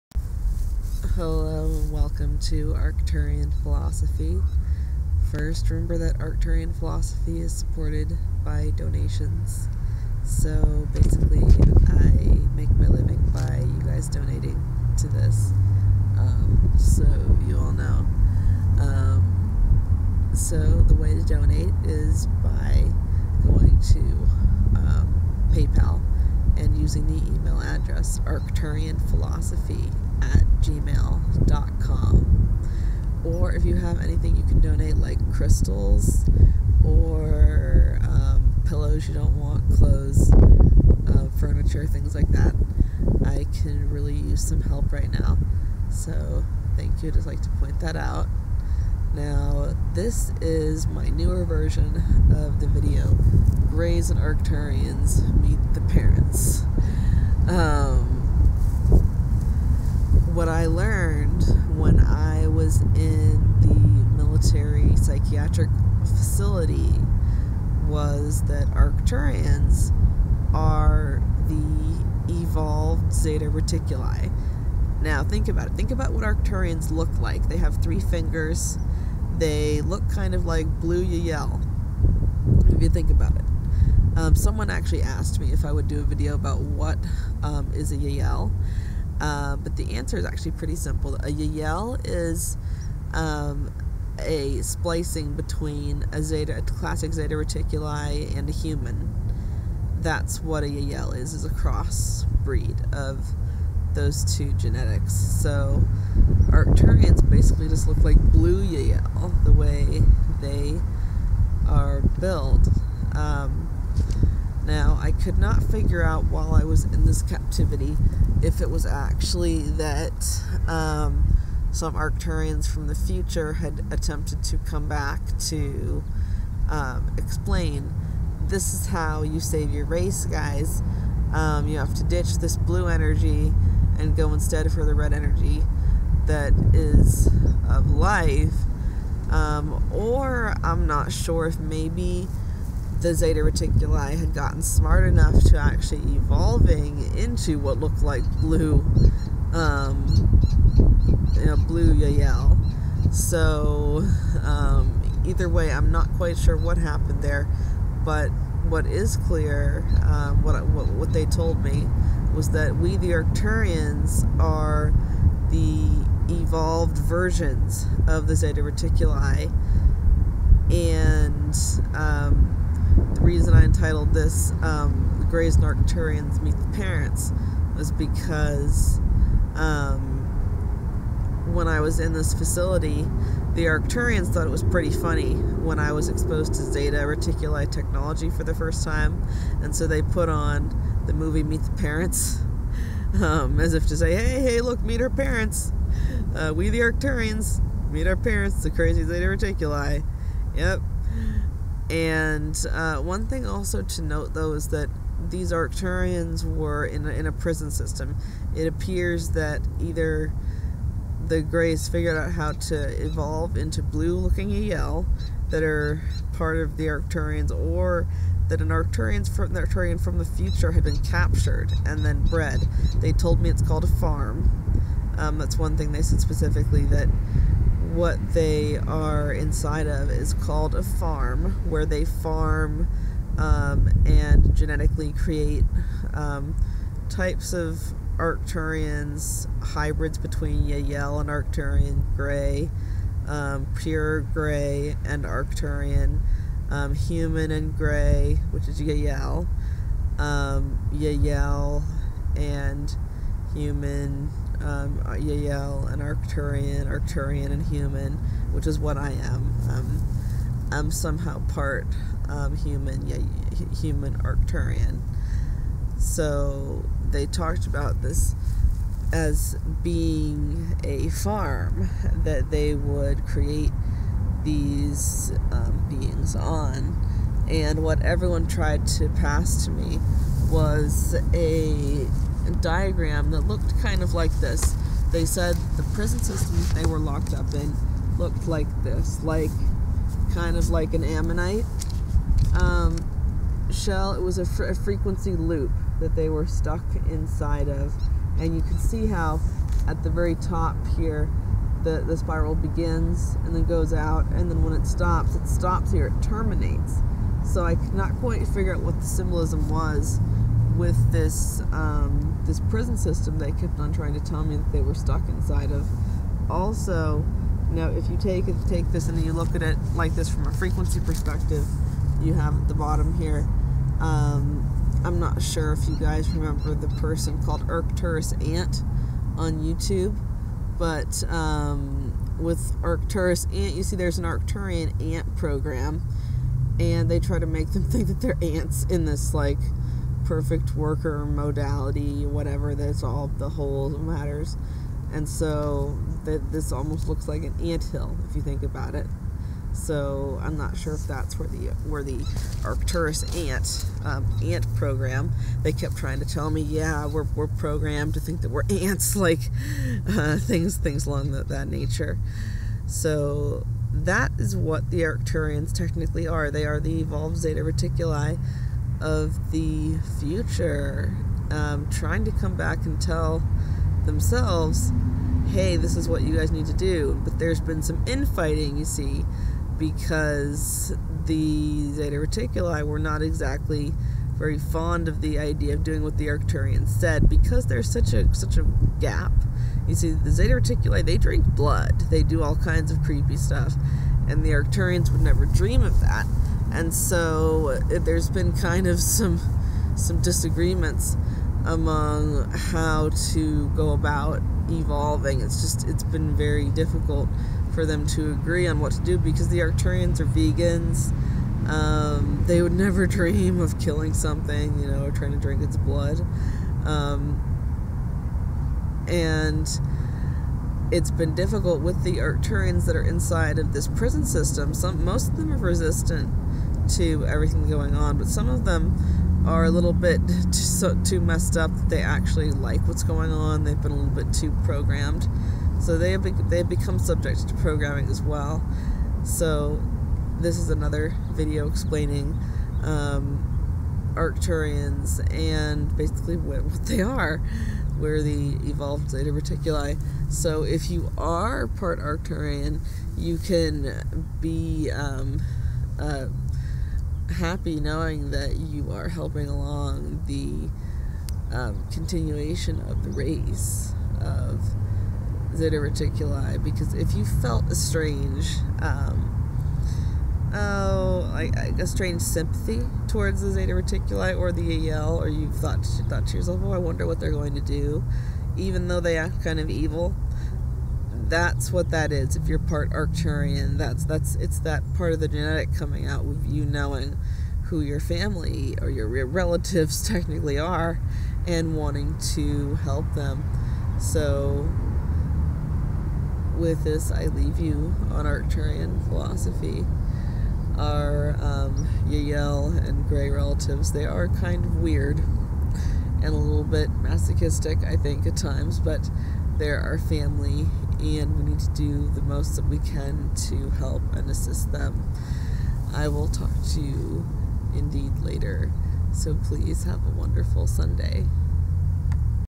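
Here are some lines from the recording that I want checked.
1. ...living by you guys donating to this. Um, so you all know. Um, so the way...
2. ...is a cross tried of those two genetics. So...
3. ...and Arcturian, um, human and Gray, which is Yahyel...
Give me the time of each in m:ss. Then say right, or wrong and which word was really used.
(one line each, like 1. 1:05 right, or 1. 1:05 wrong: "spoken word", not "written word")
1. 0:12 right
2. 1:41 wrong: "breed", not "tried"
3. 4:05 right.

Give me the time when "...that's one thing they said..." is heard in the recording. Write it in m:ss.
3:45.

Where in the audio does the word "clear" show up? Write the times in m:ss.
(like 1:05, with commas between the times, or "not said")
2:39.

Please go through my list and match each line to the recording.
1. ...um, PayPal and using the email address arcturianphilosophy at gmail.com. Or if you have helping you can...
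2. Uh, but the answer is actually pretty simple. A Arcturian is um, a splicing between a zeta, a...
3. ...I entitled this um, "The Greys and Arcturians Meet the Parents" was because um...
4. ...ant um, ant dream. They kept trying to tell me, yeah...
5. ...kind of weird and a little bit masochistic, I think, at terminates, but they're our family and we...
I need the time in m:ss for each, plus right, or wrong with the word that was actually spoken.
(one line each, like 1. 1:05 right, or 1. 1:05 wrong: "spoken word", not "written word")
1. 0:24 wrong: "anything", not "helping"
2. 1:29 wrong: "Yahyel", not "Arcturian"
3. 2:53 right
4. 5:53 wrong: "program", not "dream"
5. 8:24 wrong: "times", not "terminates".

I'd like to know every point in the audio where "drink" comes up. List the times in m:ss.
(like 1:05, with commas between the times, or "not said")
6:31, 6:55.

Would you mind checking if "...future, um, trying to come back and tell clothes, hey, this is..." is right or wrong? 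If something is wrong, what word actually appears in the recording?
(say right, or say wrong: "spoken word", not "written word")
wrong: "themselves", not "clothes".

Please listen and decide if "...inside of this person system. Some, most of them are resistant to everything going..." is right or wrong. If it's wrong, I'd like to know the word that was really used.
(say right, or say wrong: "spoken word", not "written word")
wrong: "prison", not "person".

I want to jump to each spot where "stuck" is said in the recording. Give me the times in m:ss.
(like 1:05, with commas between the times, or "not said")
4:56, 5:14.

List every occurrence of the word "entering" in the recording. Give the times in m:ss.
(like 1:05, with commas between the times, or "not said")
not said.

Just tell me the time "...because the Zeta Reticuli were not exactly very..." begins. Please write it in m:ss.
6:19.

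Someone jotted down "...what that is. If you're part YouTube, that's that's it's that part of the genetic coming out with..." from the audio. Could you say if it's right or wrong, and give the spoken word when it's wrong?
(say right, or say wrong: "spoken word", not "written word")
wrong: "Arcturian", not "YouTube".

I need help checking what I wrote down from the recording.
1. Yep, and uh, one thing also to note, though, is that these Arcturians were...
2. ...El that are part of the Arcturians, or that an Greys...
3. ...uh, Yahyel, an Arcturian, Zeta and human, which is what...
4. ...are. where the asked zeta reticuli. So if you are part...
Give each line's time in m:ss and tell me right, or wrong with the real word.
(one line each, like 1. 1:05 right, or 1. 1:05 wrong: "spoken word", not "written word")
1. 3:20 right
2. 3:34 wrong: "Arcturian", not "Greys"
3. 4:15 wrong: "Arcturian", not "Zeta"
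4. 7:27 wrong: "evolved", not "asked".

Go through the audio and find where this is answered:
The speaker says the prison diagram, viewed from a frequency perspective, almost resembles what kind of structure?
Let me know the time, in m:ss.
5:47.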